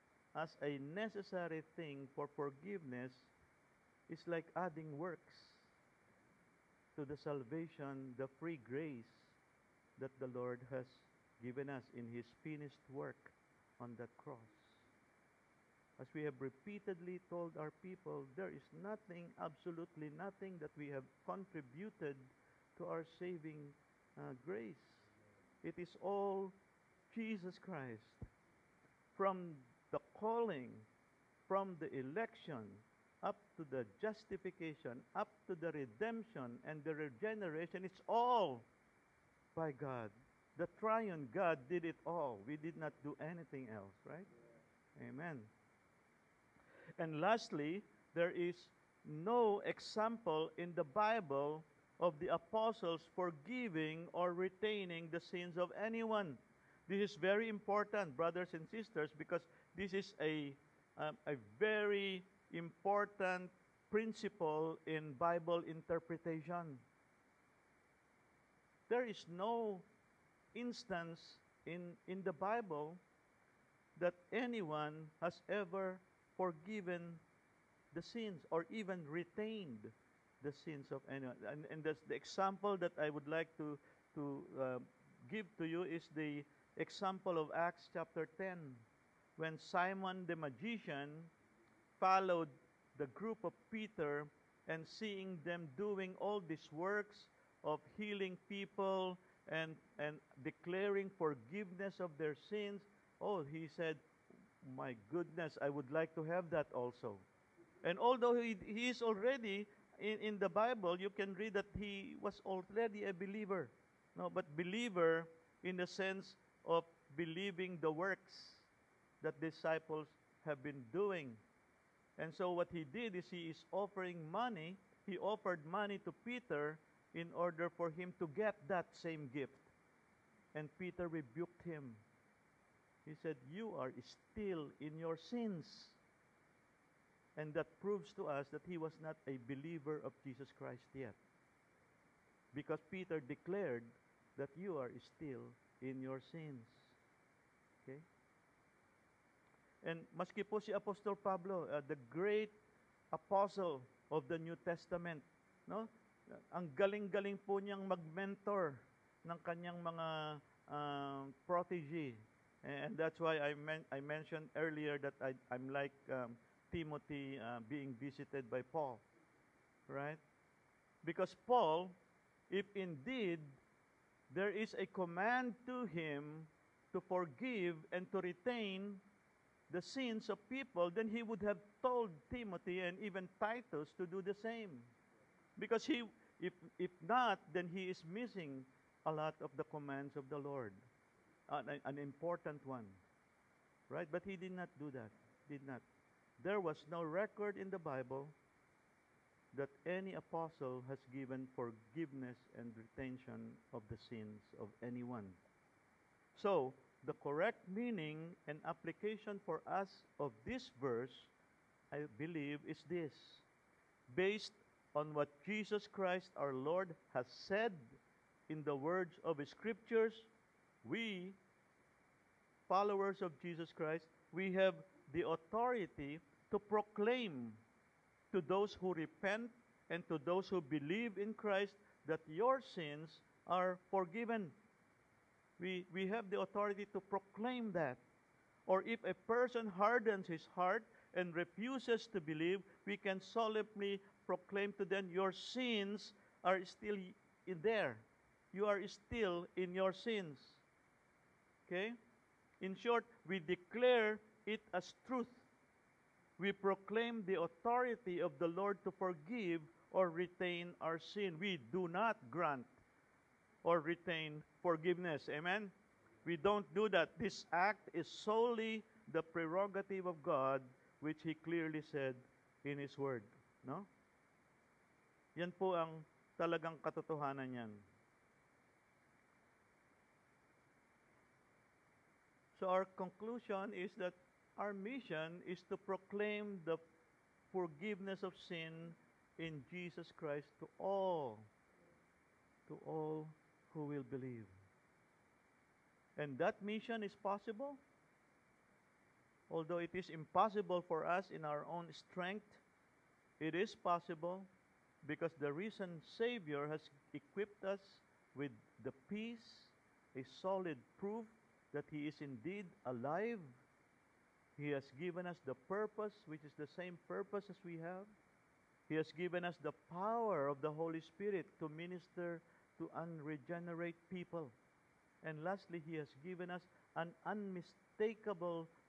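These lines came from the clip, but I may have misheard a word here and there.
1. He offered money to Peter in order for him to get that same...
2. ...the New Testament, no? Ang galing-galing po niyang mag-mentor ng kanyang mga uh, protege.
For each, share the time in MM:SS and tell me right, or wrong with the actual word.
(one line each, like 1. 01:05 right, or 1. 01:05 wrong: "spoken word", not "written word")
1. 02:05 right
2. 02:34 right.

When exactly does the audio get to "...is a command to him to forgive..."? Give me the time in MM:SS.
02:54.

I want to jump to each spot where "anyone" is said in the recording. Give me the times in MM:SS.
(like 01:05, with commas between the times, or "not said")
00:55, 01:14, 01:21, 03:24.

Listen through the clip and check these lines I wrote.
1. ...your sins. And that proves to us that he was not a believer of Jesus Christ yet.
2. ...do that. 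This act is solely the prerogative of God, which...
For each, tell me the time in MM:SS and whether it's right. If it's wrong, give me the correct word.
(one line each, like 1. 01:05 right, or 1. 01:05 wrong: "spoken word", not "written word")
1. 02:14 right
2. 04:26 right.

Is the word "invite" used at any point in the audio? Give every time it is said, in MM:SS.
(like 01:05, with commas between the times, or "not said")
not said.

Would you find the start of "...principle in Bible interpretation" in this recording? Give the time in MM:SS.
01:03.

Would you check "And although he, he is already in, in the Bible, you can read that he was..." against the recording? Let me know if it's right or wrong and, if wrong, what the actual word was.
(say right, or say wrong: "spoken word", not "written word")
right.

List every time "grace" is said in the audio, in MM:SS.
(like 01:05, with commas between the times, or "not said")
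00:08, 00:24.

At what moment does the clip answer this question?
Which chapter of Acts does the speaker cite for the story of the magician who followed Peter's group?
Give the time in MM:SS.
01:27.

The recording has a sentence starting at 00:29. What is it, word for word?
From the calling, from the election, up to the justification, up to the redemption and the regeneration, it's all by God.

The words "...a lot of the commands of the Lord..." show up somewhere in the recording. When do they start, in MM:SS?
03:09.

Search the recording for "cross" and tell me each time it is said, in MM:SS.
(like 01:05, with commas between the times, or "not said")
00:14.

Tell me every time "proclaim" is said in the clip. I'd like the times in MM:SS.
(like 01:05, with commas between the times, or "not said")
03:46, 03:57, 04:04, 04:16, 04:45.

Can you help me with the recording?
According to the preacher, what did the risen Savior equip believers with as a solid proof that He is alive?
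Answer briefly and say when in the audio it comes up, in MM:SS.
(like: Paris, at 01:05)
Peace, at 05:08.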